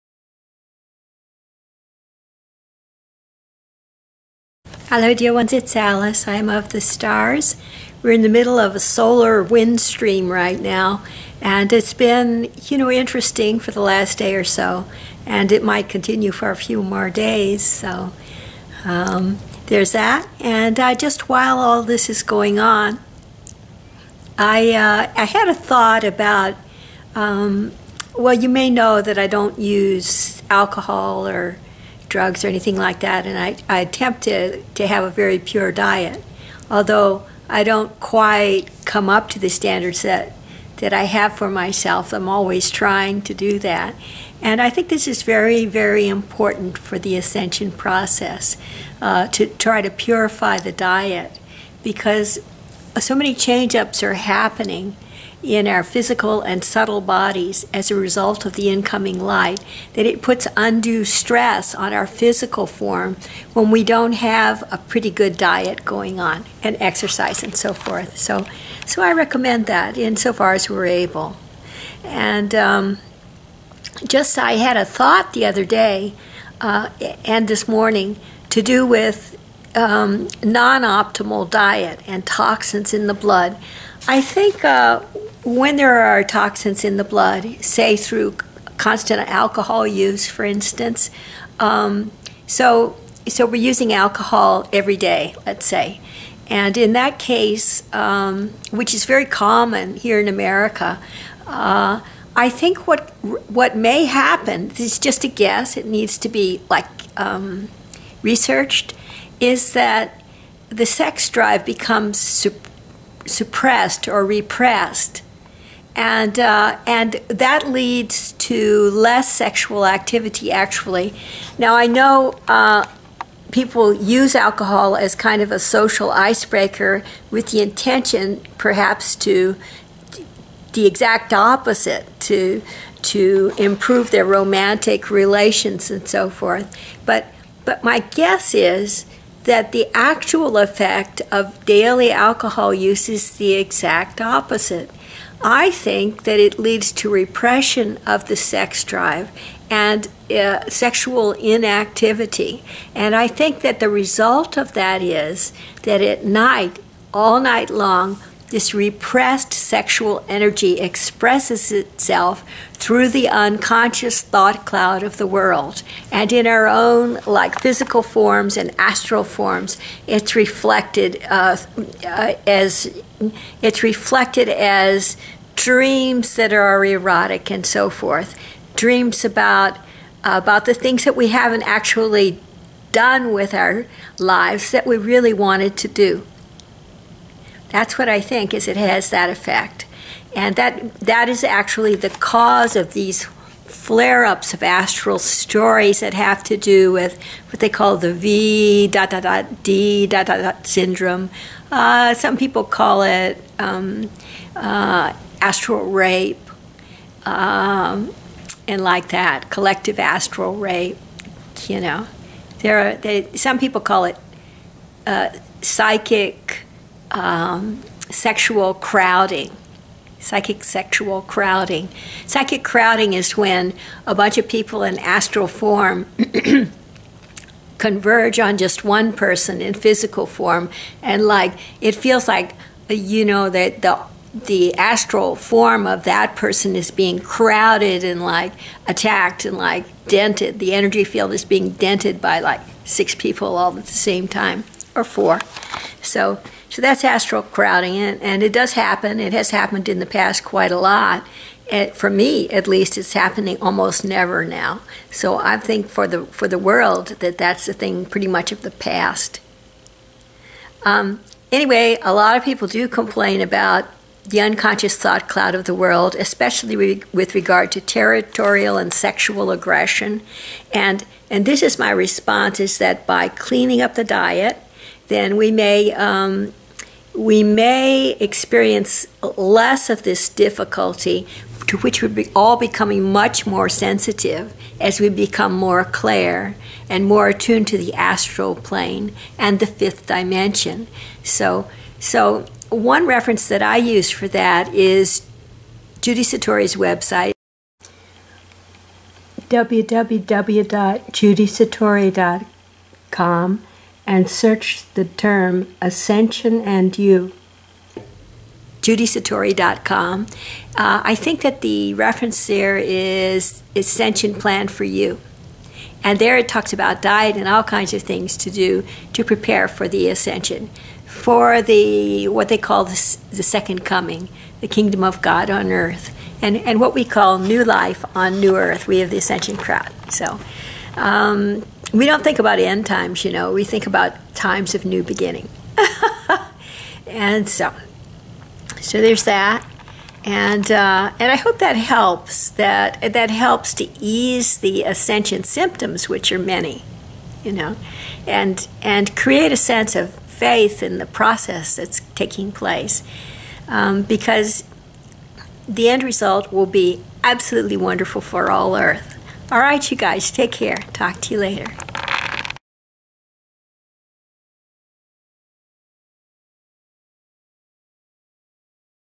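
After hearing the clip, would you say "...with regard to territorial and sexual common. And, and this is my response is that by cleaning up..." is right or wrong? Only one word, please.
wrong.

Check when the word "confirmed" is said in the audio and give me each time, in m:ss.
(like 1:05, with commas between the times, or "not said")
not said.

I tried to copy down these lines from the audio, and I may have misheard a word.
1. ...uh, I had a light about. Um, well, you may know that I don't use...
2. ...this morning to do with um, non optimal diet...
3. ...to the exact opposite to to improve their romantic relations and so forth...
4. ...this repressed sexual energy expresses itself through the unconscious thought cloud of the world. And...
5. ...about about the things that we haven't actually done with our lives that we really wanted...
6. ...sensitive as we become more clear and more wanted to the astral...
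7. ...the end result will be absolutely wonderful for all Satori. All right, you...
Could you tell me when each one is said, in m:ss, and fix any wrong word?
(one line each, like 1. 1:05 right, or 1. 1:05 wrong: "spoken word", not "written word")
1. 0:24 wrong: "thought", not "light"
2. 1:17 right
3. 2:09 right
4. 2:38 right
5. 2:59 right
6. 4:43 wrong: "attuned", not "wanted"
7. 5:55 wrong: "Earth", not "Satori".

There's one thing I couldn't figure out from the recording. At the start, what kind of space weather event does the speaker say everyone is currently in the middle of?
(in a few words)
solar wind stream.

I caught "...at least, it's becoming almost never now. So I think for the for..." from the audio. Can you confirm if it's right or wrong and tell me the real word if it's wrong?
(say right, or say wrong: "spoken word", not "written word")
wrong: "happening", not "becoming".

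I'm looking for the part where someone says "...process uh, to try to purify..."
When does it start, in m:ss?
0:47.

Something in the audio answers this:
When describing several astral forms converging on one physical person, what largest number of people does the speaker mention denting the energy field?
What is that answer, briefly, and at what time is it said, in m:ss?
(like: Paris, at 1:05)
6, at 4:02.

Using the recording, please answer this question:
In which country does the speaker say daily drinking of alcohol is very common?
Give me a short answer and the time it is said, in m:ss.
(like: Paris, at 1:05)
America, at 1:40.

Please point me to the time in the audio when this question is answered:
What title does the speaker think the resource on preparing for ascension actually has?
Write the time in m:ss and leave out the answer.
5:13.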